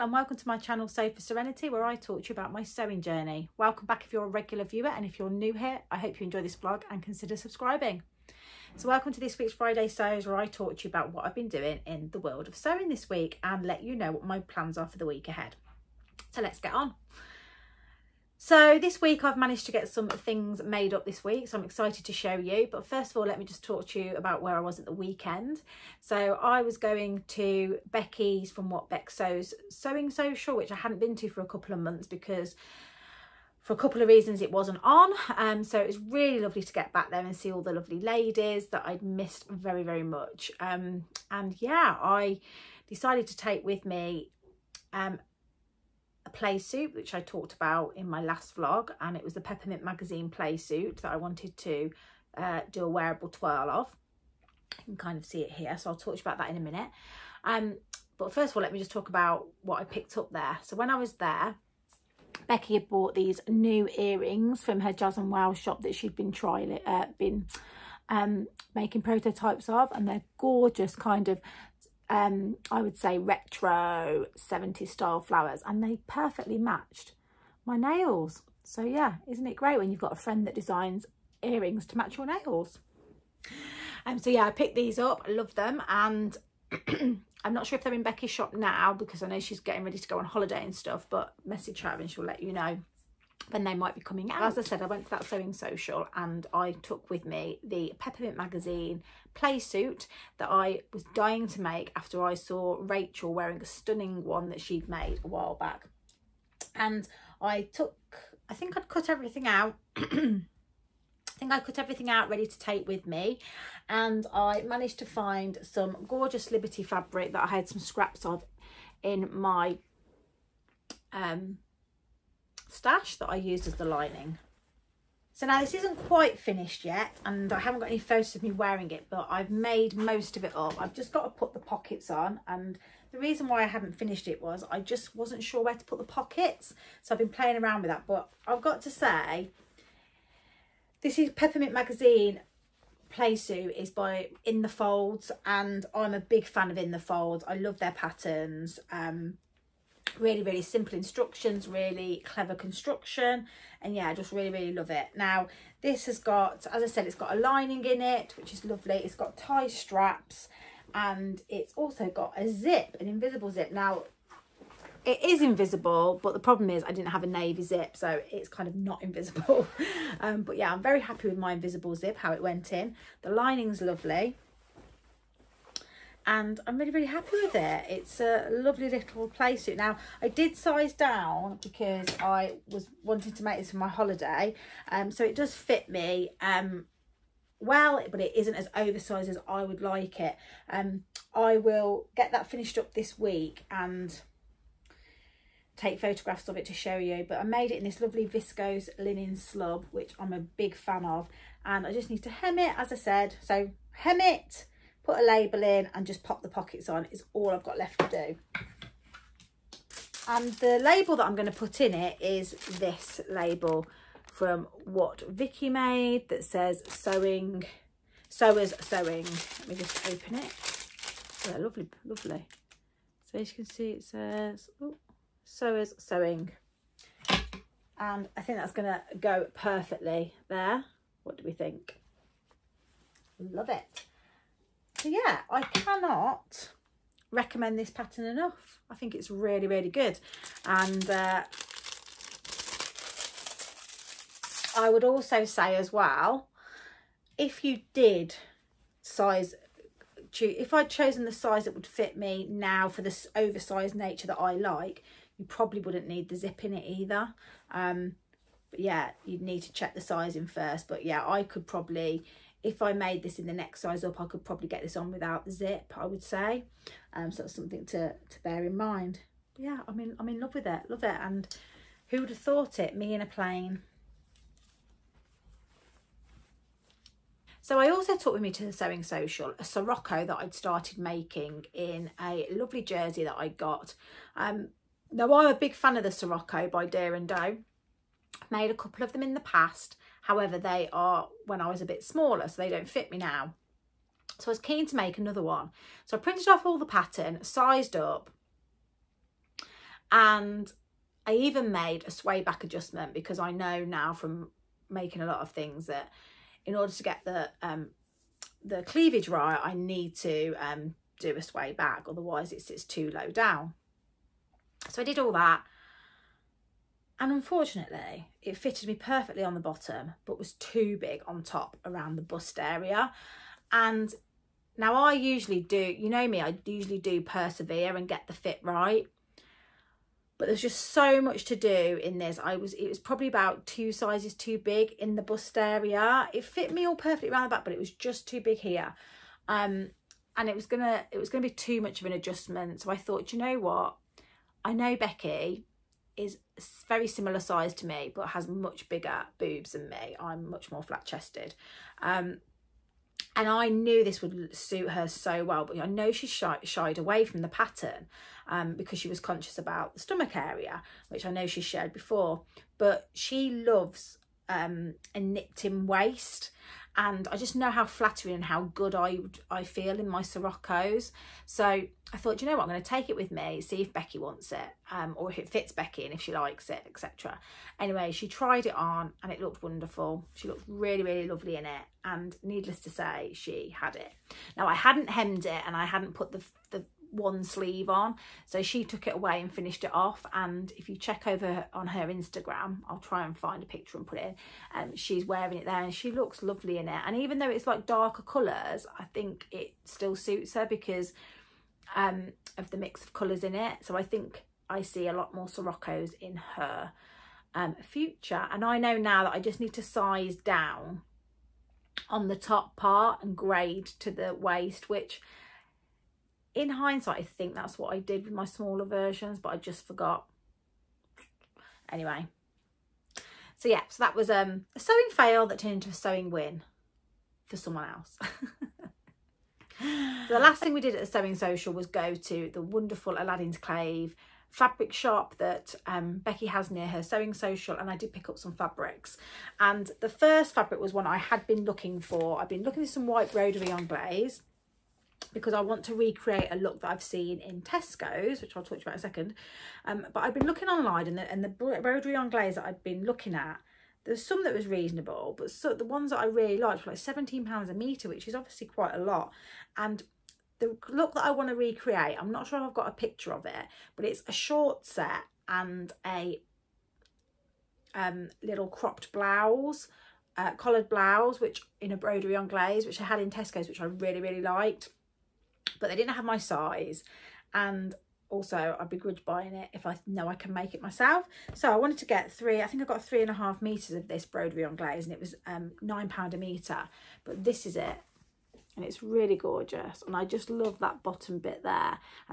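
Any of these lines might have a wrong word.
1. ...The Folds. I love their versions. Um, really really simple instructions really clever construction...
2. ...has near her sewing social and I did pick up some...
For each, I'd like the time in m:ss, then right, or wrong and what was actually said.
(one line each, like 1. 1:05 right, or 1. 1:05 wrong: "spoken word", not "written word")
1. 2:26 wrong: "patterns", not "versions"
2. 7:16 right.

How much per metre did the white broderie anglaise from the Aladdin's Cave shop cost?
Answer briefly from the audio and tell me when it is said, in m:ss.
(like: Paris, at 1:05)
£9, at 8:05.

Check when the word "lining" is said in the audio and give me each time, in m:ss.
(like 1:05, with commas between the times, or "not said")
2:03, 2:37, 2:53.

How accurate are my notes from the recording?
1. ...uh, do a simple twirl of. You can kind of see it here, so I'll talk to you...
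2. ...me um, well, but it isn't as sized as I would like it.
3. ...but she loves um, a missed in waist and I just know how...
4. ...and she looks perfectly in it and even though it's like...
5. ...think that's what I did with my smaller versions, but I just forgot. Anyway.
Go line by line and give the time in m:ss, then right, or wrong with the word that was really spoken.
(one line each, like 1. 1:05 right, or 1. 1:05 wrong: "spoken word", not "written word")
1. 0:52 wrong: "wearable", not "simple"
2. 3:05 wrong: "oversized", not "sized"
3. 6:02 wrong: "nipped", not "missed"
4. 6:35 wrong: "lovely", not "perfectly"
5. 6:57 right.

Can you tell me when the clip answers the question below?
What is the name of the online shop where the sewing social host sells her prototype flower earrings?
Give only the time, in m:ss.
1:04.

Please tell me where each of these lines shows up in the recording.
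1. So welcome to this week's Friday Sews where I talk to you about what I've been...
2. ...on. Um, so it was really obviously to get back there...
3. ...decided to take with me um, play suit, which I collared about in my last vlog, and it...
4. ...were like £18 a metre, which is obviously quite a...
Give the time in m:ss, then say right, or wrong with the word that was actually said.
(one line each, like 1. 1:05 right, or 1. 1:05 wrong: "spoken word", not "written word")
1. 0:08 right
2. 0:34 wrong: "lovely", not "obviously"
3. 0:42 wrong: "talked", not "collared"
4. 7:36 wrong: "17", not "18".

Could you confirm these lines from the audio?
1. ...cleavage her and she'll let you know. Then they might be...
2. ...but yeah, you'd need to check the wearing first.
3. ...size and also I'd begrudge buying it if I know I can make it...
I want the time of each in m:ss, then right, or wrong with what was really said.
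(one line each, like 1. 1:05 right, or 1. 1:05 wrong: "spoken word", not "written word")
1. 1:31 wrong: "message", not "cleavage"
2. 4:18 wrong: "sizing", not "wearing"
3. 7:56 right.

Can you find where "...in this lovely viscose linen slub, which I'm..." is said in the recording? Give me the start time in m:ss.
3:17.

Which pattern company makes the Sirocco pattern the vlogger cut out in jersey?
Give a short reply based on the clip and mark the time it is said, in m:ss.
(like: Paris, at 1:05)
Deer and Doe, at 4:46.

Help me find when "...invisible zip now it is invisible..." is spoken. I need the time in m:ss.
2:43.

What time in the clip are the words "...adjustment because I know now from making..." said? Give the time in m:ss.
5:02.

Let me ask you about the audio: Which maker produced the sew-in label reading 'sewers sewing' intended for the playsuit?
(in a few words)
What Vicky Made.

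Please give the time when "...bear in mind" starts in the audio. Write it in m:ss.
4:28.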